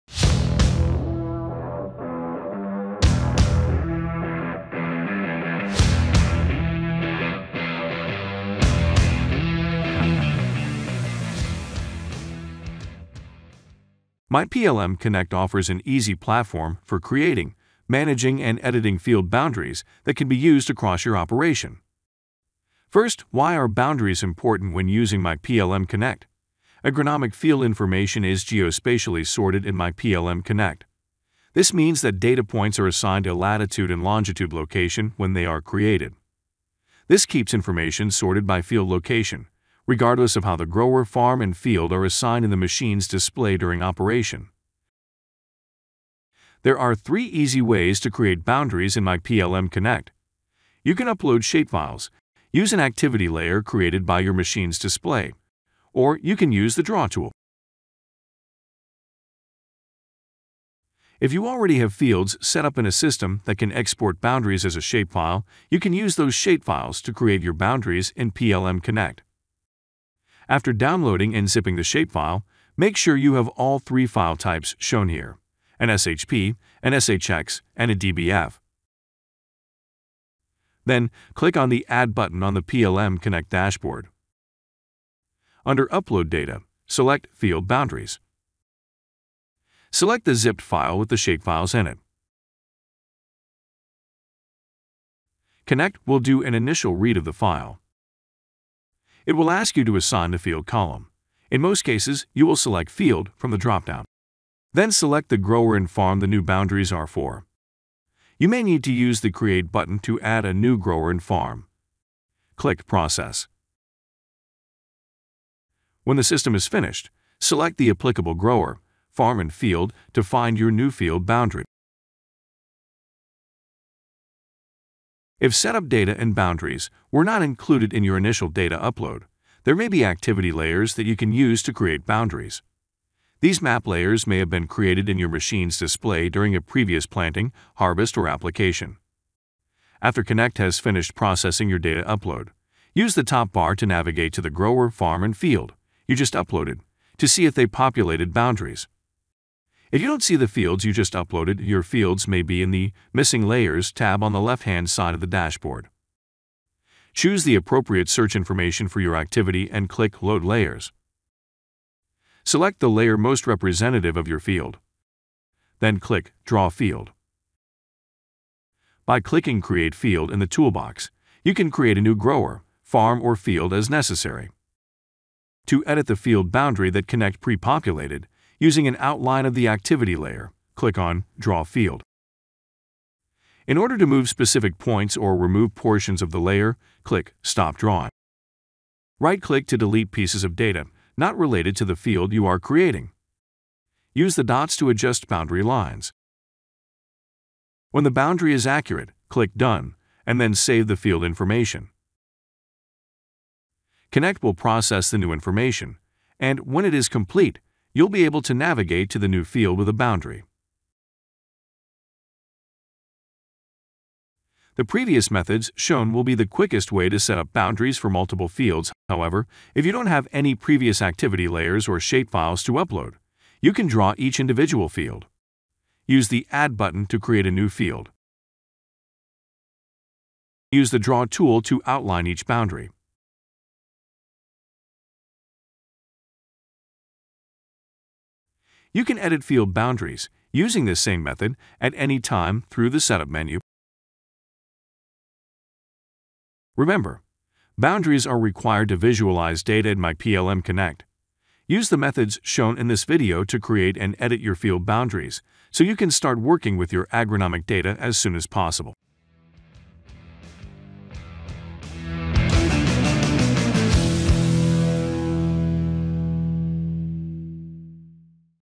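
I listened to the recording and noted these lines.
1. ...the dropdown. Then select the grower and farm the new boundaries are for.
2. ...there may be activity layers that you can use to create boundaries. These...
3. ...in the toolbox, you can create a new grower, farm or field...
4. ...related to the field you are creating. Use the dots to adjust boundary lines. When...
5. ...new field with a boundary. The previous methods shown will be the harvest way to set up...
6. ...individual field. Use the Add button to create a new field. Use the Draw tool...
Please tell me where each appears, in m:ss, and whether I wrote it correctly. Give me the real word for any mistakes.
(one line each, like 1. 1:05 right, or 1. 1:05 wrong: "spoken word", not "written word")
1. 1:43 right
2. 2:09 right
3. 2:50 right
4. 3:11 right
5. 3:29 wrong: "quickest", not "harvest"
6. 3:44 right.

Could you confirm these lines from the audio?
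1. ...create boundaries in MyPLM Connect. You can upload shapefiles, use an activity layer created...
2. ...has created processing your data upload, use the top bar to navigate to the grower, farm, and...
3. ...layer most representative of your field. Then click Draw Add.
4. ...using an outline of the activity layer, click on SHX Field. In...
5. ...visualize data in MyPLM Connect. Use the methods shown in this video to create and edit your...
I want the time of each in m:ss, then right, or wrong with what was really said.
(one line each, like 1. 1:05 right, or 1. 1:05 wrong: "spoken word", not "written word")
1. 0:48 right
2. 2:20 wrong: "finished", not "created"
3. 2:42 wrong: "Field", not "Add"
4. 2:58 wrong: "Draw", not "SHX"
5. 4:08 right.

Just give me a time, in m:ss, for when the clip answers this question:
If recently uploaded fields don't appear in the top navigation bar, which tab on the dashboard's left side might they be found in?
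2:33.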